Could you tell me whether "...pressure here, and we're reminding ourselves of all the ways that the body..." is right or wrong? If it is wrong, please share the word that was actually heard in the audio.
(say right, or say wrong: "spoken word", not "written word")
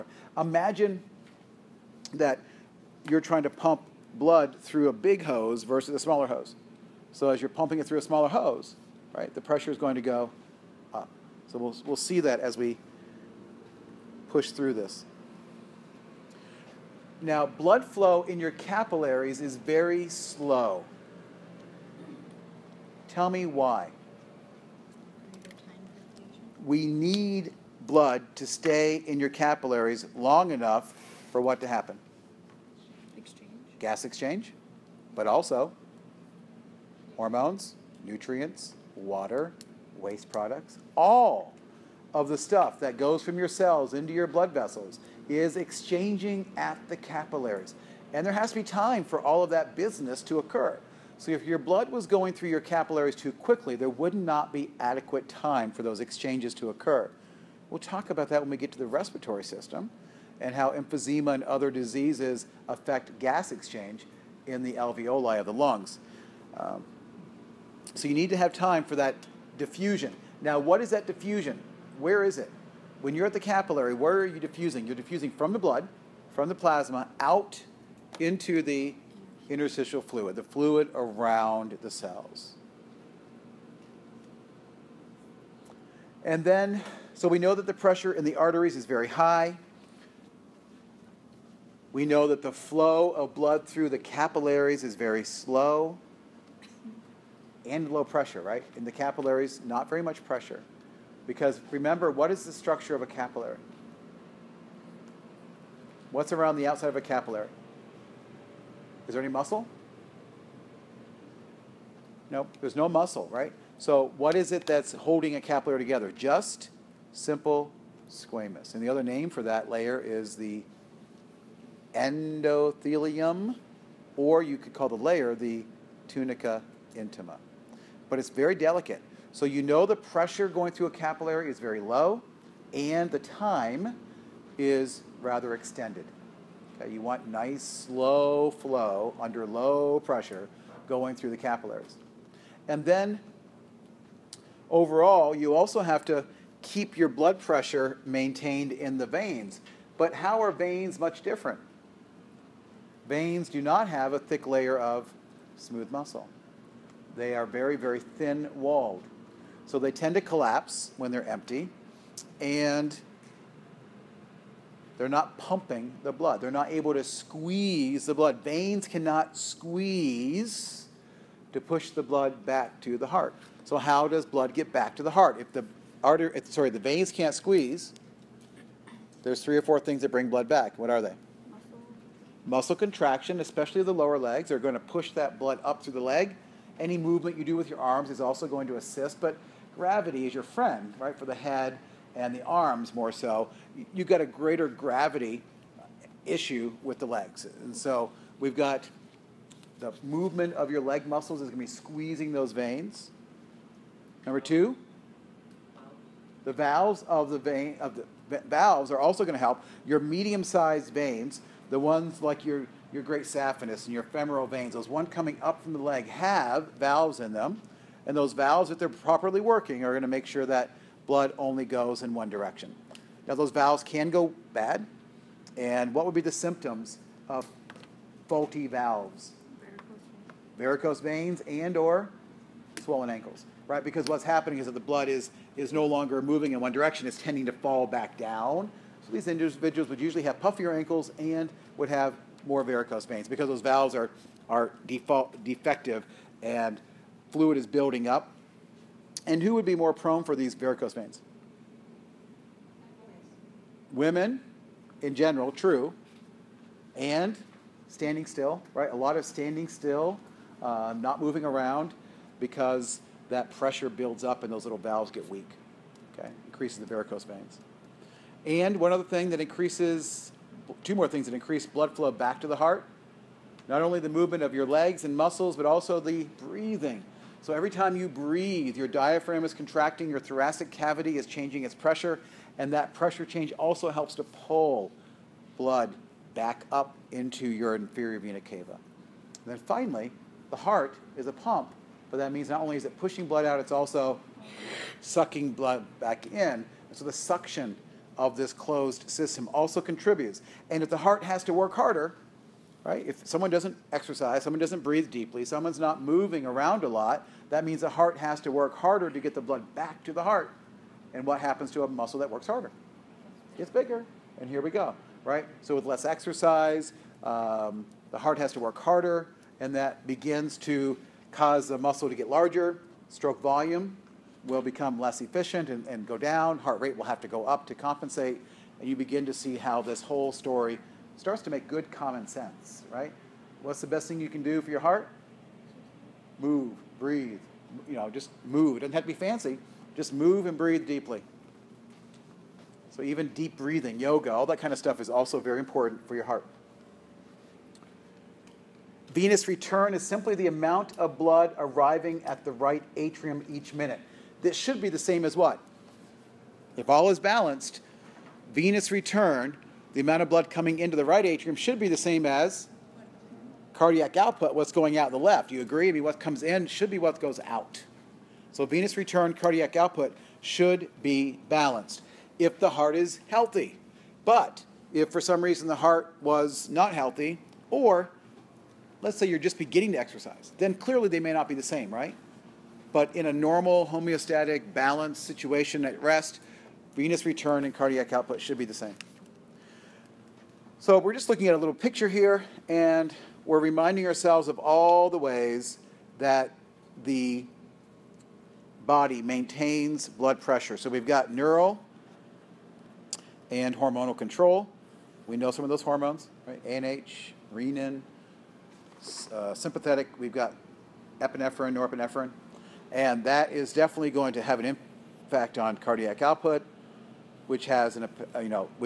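wrong: "picture", not "pressure".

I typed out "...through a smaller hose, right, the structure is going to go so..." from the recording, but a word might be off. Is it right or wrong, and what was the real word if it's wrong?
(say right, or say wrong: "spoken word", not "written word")
wrong: "pressure", not "structure".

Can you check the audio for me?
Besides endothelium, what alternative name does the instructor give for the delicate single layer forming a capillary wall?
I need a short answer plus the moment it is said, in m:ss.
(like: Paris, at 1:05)
Tunica intima, at 2:06.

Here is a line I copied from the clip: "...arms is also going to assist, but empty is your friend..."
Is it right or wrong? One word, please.
wrong.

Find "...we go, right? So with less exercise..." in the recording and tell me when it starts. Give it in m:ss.
5:14.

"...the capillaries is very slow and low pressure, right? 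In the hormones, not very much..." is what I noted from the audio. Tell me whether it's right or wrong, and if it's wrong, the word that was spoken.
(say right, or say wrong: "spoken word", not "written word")
wrong: "capillaries", not "hormones".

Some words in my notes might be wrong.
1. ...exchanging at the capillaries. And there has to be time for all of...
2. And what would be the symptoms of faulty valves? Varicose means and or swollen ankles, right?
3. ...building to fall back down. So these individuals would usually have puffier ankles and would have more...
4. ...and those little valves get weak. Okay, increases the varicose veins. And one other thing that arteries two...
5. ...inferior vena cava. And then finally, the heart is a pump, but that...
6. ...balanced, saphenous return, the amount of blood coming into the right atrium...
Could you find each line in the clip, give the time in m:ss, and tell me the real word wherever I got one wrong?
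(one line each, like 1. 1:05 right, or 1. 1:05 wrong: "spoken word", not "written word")
1. 0:45 right
2. 3:45 wrong: "veins", not "means"
3. 3:57 wrong: "tending", not "building"
4. 4:24 wrong: "increases", not "arteries"
5. 4:47 right
6. 5:57 wrong: "venous", not "saphenous".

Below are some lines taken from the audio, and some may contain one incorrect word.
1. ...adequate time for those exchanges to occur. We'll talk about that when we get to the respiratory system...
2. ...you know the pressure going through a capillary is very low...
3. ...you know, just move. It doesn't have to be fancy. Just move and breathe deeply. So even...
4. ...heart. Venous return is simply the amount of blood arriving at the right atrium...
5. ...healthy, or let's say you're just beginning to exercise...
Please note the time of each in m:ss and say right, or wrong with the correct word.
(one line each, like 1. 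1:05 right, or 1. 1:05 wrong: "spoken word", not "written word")
1. 0:54 right
2. 2:09 right
3. 5:37 right
4. 5:46 right
5. 6:16 right.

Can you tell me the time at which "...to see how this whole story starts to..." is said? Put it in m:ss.
5:29.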